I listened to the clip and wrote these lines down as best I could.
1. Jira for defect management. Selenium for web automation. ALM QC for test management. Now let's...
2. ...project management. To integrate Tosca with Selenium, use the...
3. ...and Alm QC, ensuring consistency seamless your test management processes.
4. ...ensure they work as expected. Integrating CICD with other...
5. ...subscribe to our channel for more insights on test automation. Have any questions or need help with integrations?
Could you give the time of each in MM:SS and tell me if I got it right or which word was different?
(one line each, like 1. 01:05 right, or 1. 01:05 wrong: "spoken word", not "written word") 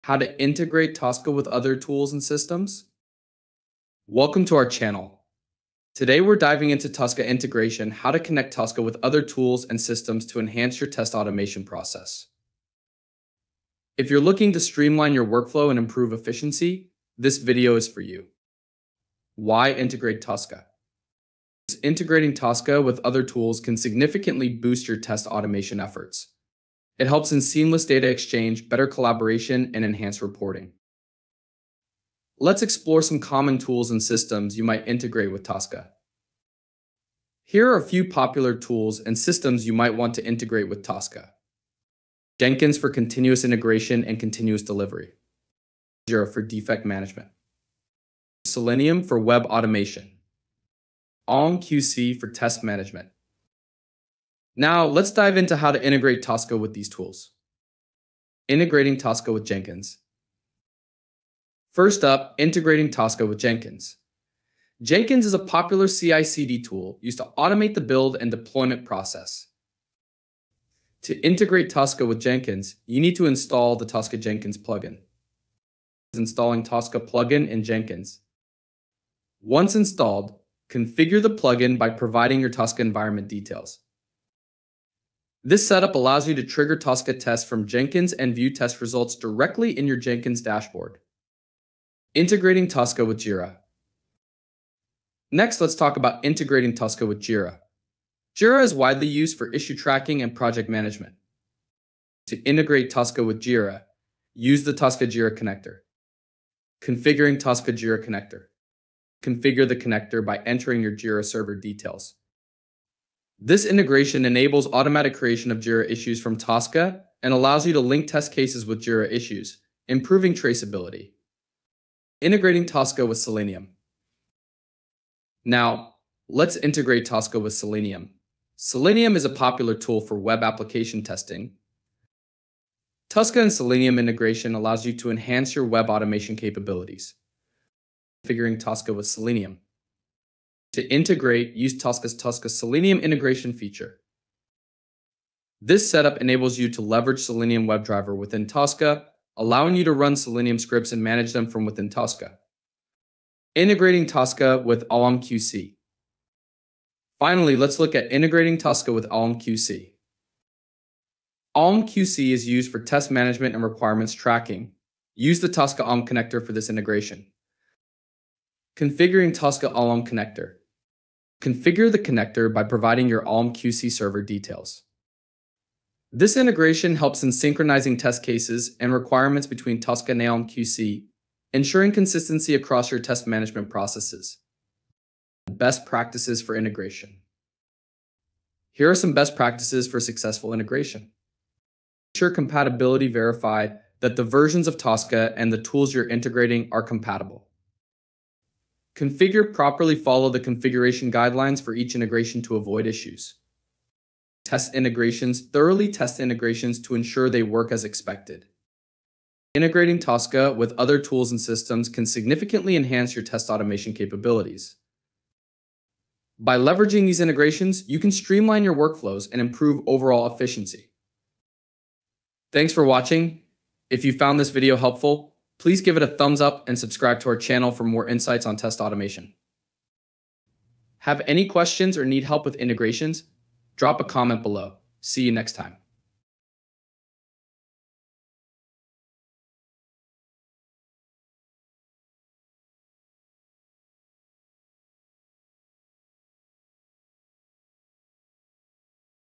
1. 00:46 right
2. 01:40 wrong: "Jira", not "Selenium"
3. 03:00 wrong: "across", not "seamless"
4. 03:26 wrong: "Tosca", not "CICD"
5. 03:46 right.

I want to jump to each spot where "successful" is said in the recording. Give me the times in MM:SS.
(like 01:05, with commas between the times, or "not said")
03:09.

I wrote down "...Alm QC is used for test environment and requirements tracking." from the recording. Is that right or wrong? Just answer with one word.
wrong.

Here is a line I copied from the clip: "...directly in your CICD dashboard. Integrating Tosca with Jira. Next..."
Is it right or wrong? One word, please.
wrong.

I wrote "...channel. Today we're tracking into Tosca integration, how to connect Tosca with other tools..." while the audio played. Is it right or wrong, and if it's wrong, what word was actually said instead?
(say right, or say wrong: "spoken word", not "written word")
wrong: "diving", not "tracking".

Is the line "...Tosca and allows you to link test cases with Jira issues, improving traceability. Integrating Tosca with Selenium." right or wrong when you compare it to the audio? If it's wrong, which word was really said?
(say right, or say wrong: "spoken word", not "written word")
right.